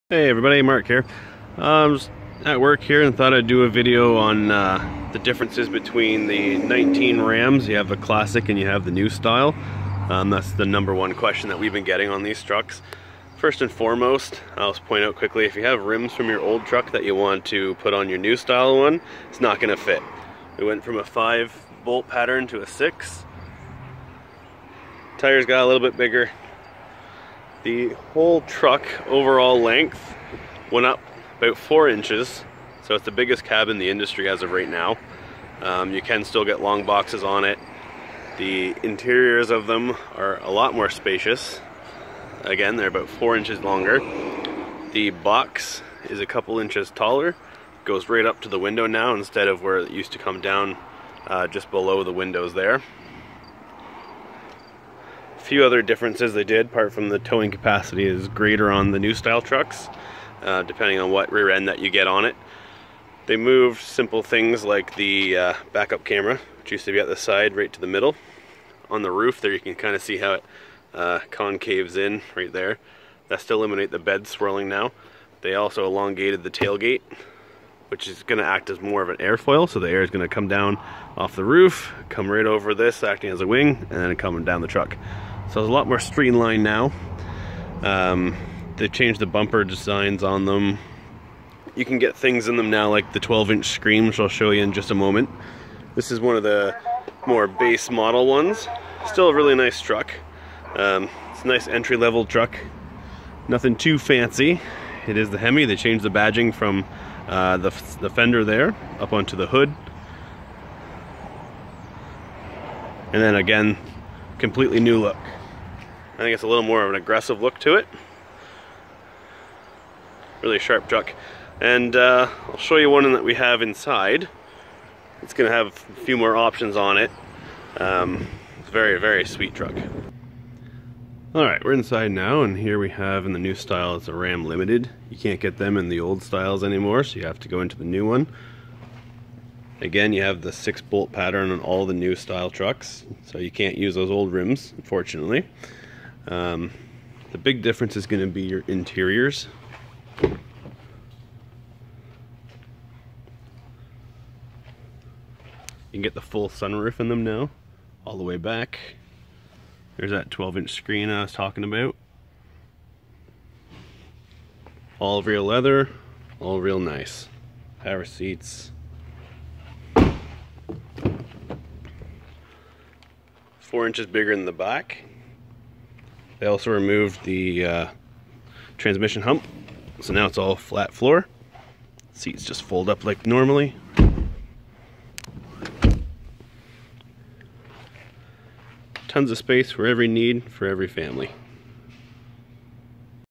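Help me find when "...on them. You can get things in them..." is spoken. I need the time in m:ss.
1:30.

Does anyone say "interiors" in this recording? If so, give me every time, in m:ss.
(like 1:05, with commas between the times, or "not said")
0:38, 2:28.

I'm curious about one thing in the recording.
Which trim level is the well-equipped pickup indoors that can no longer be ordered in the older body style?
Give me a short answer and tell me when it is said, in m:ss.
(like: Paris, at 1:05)
Ram Limited, at 2:14.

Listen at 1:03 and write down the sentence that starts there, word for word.
They moved simple things like the uh, backup camera, which used to be at the side right to the middle.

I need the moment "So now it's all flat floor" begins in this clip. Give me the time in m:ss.
2:59.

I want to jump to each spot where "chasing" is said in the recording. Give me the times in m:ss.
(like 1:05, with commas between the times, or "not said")
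not said.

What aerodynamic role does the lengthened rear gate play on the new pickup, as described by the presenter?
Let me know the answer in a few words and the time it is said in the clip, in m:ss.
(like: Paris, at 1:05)
airfoil, at 1:19.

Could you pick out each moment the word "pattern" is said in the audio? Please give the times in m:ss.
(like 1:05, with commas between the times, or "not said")
0:22, 2:21.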